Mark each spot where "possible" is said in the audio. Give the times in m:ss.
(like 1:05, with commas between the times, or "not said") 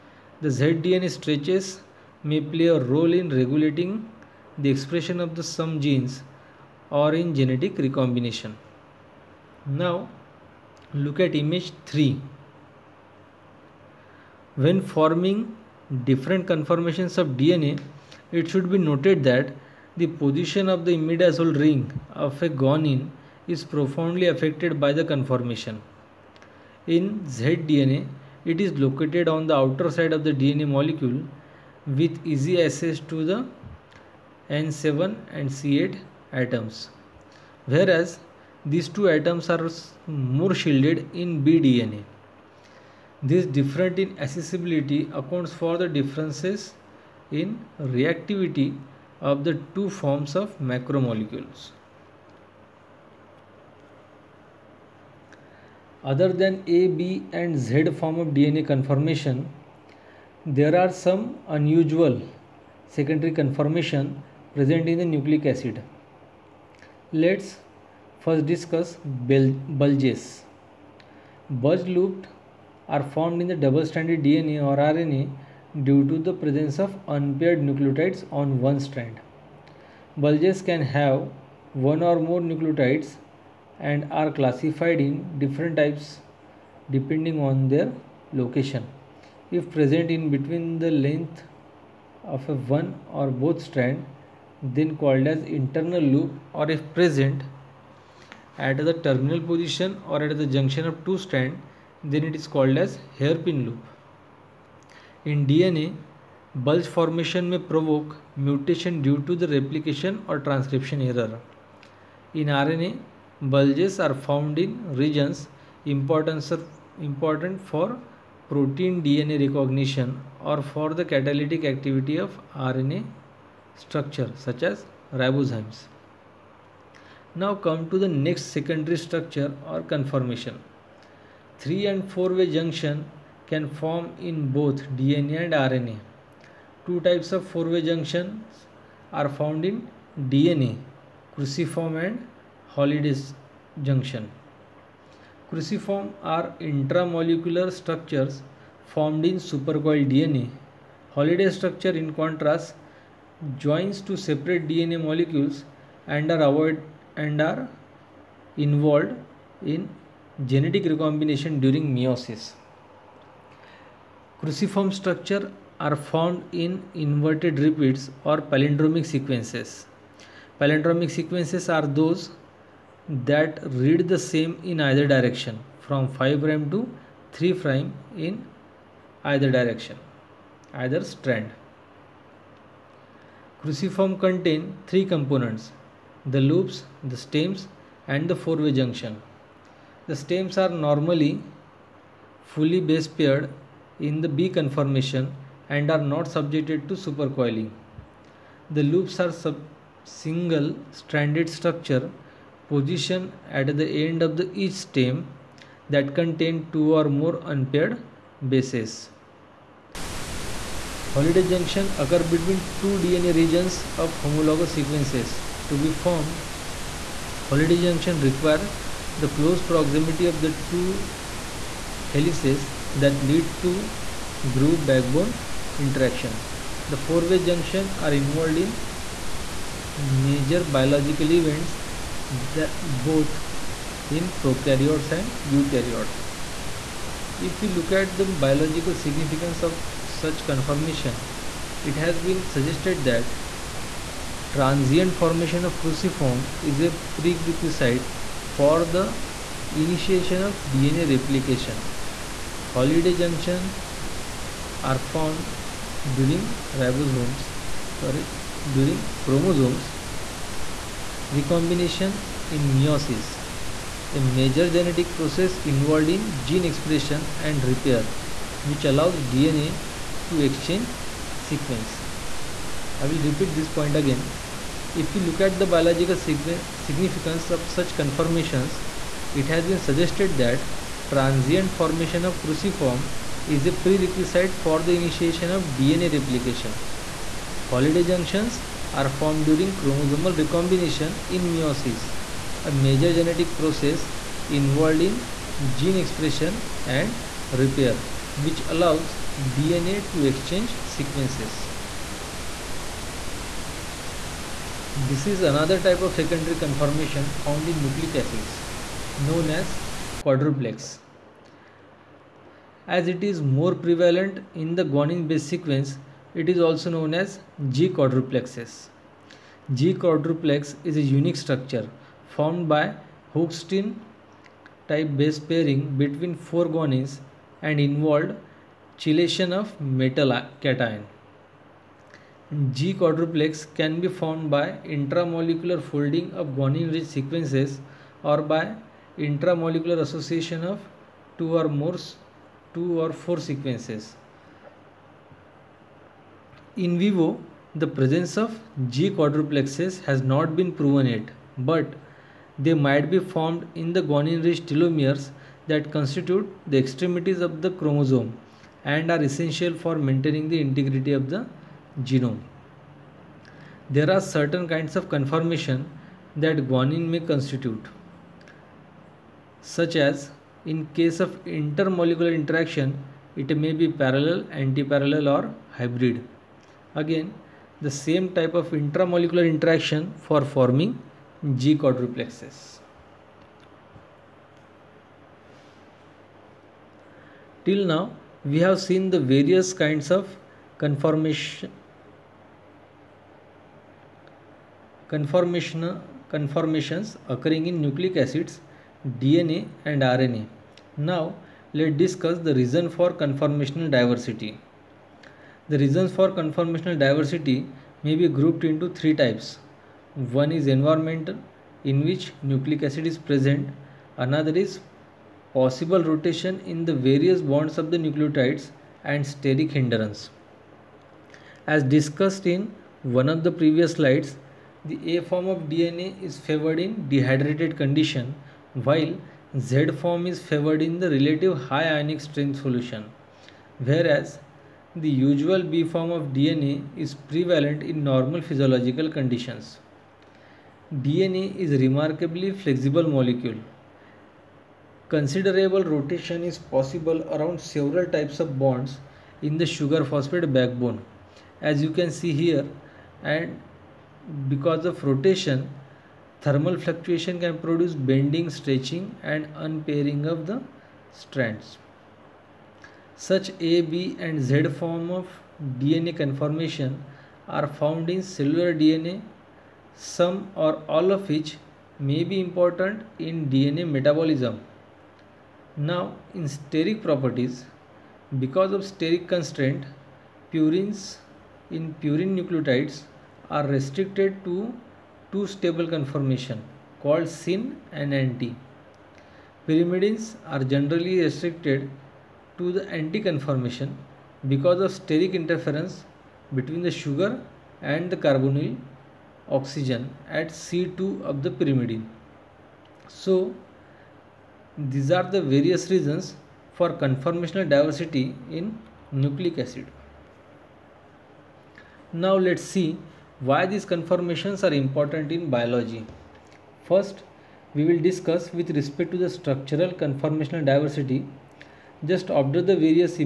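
6:55, 7:26.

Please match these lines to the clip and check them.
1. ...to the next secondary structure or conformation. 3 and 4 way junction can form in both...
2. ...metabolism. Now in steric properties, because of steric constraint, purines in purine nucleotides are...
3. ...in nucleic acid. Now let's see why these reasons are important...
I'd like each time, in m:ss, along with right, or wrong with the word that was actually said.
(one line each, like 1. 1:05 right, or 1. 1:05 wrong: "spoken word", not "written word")
1. 2:07 right
2. 7:53 right
3. 8:28 wrong: "conformations", not "reasons".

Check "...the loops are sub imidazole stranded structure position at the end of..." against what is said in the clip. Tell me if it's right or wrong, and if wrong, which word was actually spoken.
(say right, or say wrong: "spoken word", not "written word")
wrong: "single", not "imidazole".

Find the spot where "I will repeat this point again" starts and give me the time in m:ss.
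4:32.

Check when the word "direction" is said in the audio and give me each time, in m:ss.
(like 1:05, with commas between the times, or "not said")
2:55, 2:59.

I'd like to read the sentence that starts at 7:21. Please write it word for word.
DNA is a remarkably flexible molecule.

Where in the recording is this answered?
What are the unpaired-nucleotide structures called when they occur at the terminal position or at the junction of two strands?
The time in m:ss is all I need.
1:43.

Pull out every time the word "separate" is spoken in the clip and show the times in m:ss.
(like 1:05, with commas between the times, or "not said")
2:34.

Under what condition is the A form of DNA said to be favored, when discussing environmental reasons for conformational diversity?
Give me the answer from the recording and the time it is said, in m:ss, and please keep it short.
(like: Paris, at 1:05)
Dehydrated condition, at 7:07.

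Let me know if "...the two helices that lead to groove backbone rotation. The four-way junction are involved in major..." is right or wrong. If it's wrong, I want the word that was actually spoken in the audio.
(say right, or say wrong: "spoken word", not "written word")
wrong: "interaction", not "rotation".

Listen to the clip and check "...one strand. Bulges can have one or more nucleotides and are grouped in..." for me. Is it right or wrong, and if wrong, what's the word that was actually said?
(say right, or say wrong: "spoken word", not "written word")
wrong: "classified", not "grouped".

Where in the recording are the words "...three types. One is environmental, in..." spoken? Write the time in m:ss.
6:48.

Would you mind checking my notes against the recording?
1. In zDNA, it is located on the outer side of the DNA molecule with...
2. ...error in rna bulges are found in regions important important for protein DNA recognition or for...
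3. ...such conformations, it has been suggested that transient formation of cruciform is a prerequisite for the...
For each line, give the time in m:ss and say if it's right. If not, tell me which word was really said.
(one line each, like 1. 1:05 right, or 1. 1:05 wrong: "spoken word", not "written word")
1. 0:26 right
2. 1:51 right
3. 4:37 right.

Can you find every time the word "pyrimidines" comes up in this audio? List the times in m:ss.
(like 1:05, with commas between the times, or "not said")
8:09, 8:21.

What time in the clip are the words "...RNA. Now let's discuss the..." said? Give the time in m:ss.
6:40.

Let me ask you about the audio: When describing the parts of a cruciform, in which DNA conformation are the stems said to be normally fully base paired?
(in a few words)
B conformation.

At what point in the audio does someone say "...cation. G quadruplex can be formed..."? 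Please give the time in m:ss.
5:30.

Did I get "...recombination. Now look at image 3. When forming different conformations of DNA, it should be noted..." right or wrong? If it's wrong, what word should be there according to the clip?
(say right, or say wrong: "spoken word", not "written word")
right.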